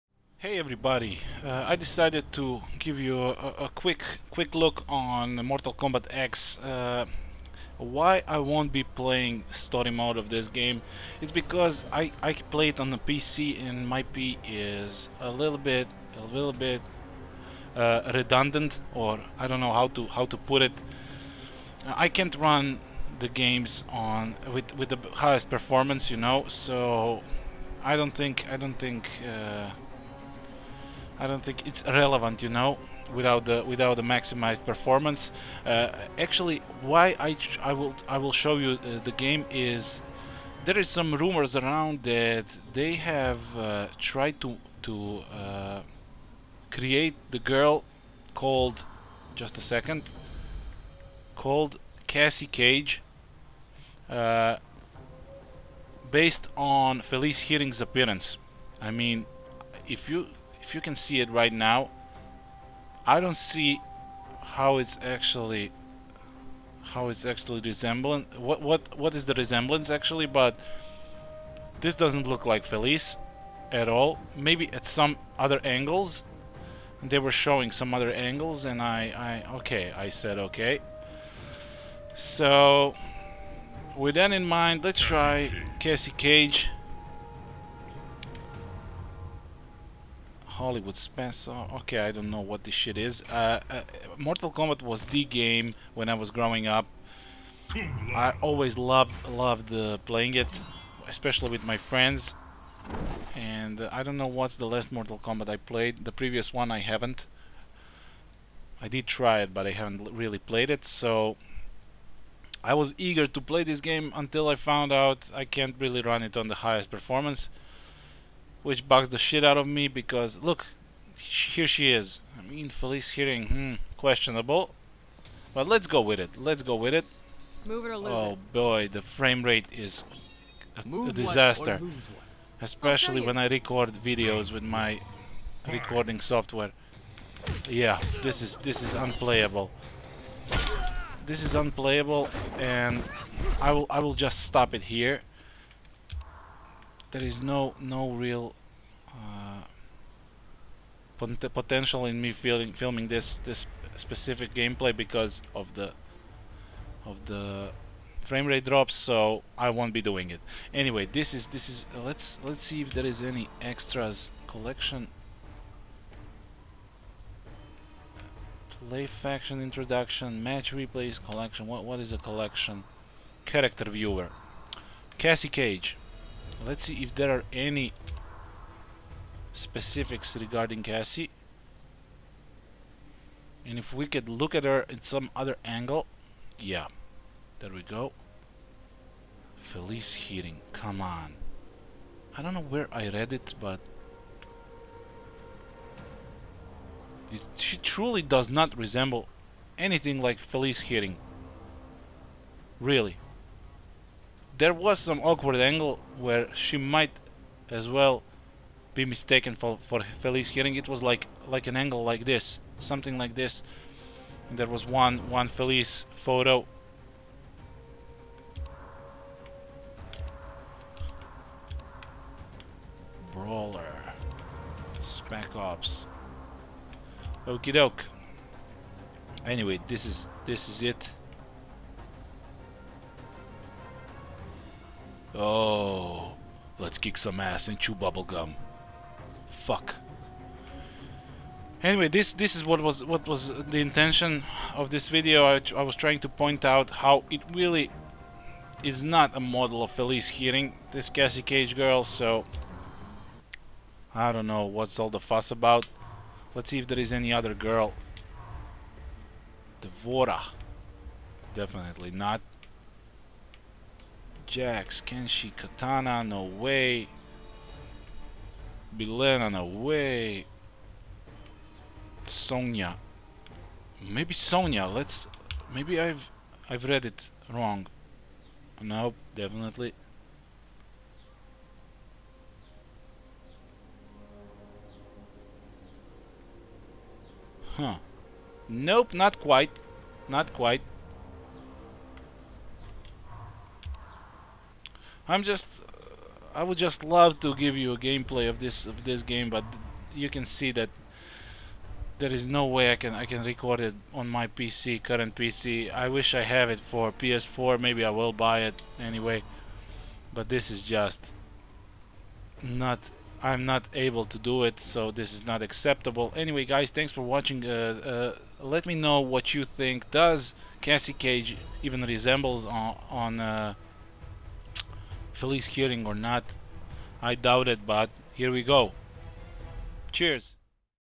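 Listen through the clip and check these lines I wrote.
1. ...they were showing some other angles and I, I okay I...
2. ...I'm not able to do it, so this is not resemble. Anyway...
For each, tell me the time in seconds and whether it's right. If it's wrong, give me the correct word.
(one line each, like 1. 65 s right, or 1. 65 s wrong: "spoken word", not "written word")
1. 77 s right
2. 313 s wrong: "acceptable", not "resemble".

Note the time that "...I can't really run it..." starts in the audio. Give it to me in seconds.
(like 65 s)
115 s.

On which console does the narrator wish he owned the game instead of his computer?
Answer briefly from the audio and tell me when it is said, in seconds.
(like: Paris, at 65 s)
PS4, at 307 s.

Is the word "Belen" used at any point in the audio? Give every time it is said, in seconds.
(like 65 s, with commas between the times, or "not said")
268 s.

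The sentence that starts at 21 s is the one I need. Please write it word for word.
I can't run the games on with with the highest performance, you know.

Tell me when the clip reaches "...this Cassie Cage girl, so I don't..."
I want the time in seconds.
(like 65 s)
250 s.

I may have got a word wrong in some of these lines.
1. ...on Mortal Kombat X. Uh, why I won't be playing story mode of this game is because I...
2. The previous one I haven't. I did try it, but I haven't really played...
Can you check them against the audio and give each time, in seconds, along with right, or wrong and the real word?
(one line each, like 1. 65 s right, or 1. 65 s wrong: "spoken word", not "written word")
1. 4 s right
2. 106 s right.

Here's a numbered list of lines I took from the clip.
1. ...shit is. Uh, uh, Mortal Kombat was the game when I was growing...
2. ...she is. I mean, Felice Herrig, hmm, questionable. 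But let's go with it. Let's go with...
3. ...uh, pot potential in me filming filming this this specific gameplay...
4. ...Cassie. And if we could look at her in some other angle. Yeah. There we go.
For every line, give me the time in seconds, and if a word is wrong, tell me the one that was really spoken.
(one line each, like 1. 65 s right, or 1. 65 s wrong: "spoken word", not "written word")
1. 92 s right
2. 121 s right
3. 149 s right
4. 180 s right.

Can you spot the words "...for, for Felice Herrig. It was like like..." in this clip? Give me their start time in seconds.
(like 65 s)
209 s.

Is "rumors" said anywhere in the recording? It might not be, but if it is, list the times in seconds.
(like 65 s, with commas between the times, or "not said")
41 s.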